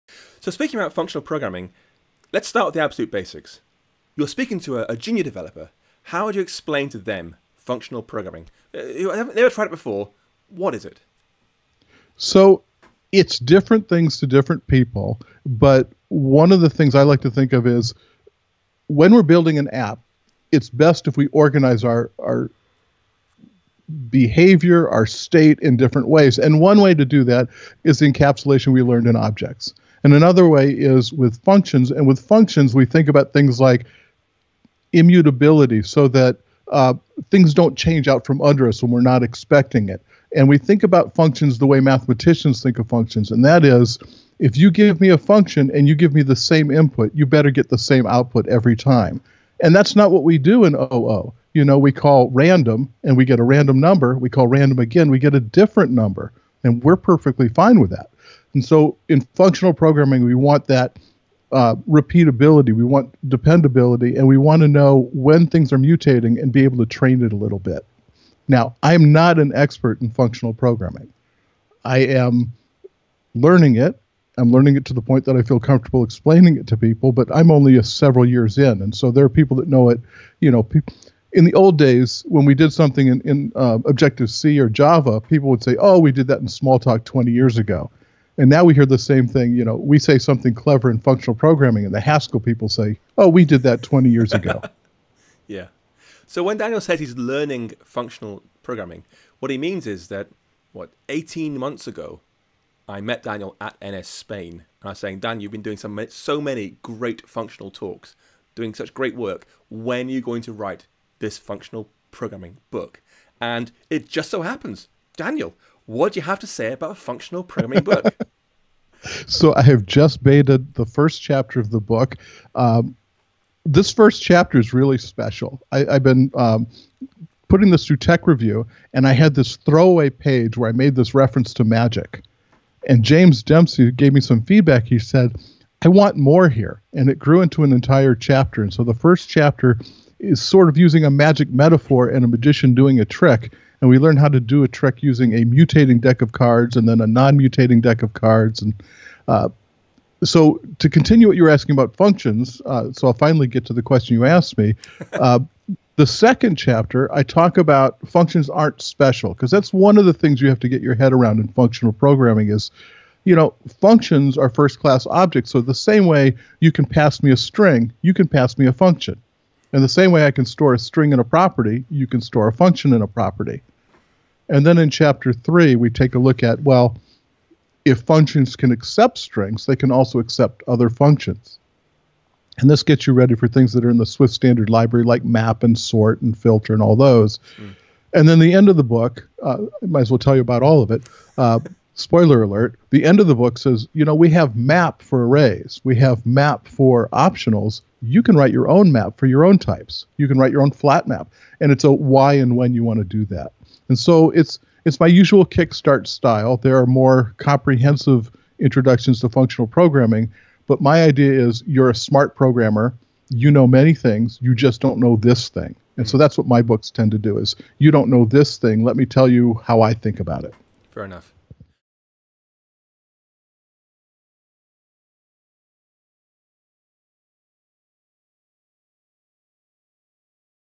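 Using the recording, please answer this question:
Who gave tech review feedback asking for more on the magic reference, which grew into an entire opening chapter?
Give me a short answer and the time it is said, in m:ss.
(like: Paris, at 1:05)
James Dempsey, at 2:13.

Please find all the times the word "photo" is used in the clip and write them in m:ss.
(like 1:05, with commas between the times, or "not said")
not said.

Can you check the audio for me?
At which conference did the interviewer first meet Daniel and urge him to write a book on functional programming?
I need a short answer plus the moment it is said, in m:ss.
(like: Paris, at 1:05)
NSSpain, at 1:43.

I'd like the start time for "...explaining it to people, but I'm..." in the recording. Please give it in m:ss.
1:16.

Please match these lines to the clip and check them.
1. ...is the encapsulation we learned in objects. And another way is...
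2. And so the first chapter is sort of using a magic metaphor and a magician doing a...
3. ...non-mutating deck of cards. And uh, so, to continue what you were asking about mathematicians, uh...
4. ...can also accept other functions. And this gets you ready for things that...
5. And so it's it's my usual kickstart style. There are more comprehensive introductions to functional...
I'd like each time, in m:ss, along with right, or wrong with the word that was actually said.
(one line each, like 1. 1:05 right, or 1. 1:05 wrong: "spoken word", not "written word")
1. 0:27 right
2. 2:18 right
3. 2:27 wrong: "functions", not "mathematicians"
4. 2:59 right
5. 3:23 right.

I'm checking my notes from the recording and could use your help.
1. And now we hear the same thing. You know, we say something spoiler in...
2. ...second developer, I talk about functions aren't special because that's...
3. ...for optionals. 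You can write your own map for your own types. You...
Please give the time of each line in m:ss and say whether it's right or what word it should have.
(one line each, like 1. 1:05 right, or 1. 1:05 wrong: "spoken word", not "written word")
1. 1:28 wrong: "clever", not "spoiler"
2. 2:36 wrong: "chapter", not "developer"
3. 3:16 right.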